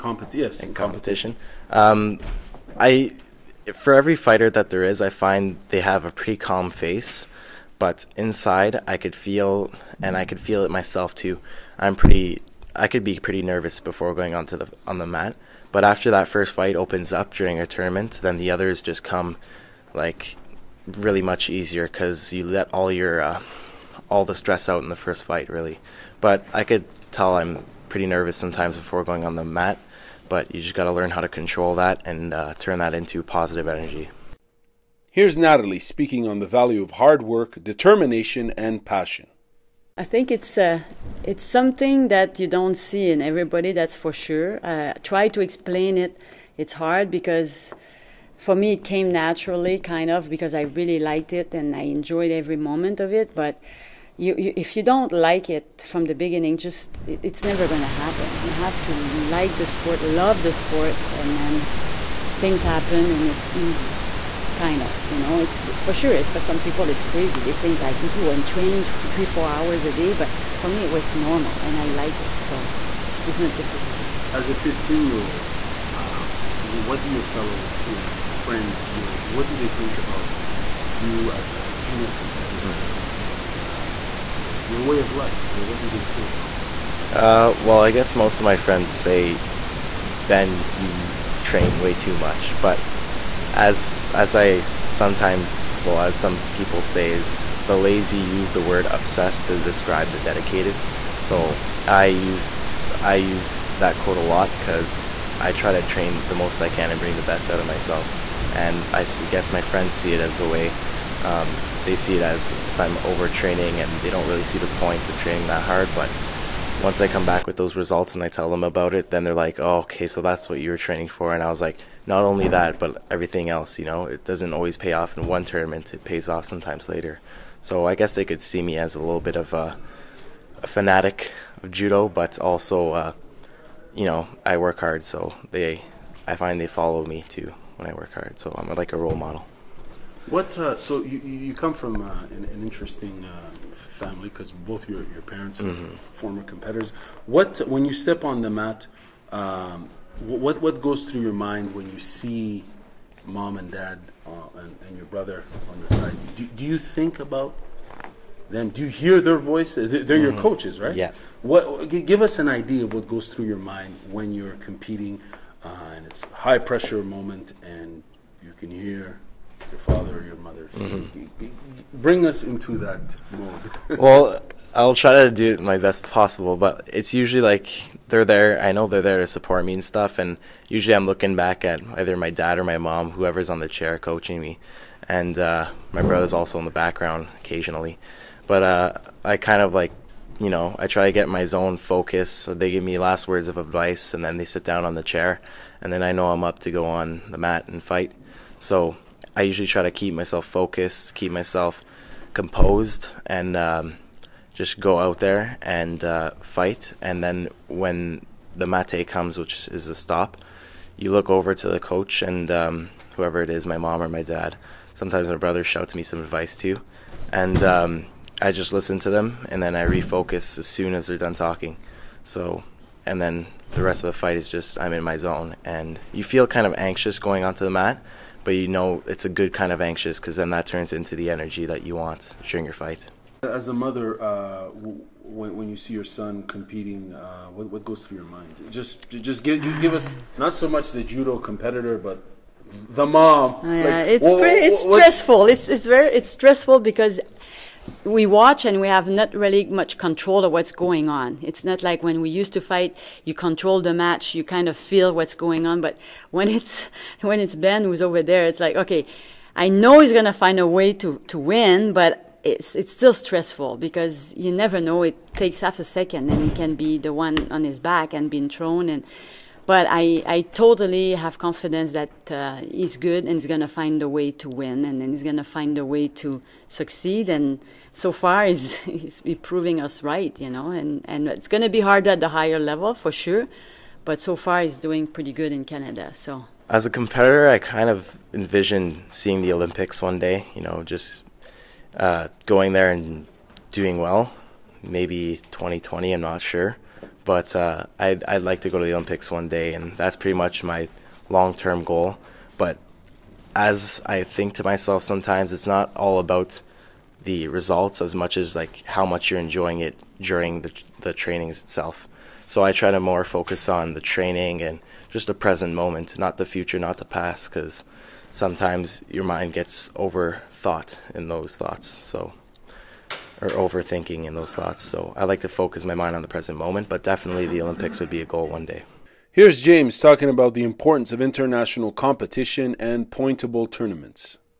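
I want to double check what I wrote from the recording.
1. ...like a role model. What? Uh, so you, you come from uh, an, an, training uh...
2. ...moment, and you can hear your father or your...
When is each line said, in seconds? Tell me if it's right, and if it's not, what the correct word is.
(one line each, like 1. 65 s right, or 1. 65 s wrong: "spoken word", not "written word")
1. 138 s wrong: "interesting", not "training"
2. 167 s right.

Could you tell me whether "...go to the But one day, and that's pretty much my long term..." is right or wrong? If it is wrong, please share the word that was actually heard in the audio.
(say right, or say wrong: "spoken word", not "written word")
wrong: "Olympics", not "But".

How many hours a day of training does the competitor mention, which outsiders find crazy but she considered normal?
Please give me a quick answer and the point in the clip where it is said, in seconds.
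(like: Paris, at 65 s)
3 or 4, at 68 s.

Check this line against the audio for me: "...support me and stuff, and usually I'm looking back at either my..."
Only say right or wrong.
right.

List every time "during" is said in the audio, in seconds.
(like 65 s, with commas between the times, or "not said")
17 s, 232 s, 310 s.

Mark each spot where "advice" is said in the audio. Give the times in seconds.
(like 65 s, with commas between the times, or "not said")
193 s, 216 s.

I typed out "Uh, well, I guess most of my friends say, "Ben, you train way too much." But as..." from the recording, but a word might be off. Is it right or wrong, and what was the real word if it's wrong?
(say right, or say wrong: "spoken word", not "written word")
right.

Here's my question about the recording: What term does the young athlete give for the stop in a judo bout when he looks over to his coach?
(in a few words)
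mate.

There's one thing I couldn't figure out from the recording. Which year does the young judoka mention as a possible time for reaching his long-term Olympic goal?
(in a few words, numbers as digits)
2020.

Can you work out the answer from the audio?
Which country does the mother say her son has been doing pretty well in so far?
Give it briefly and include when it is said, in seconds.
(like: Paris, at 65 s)
Canada, at 285 s.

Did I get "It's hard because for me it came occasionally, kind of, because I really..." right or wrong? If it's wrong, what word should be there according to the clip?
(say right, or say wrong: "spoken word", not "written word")
wrong: "naturally", not "occasionally".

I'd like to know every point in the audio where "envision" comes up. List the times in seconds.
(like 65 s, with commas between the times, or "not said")
288 s.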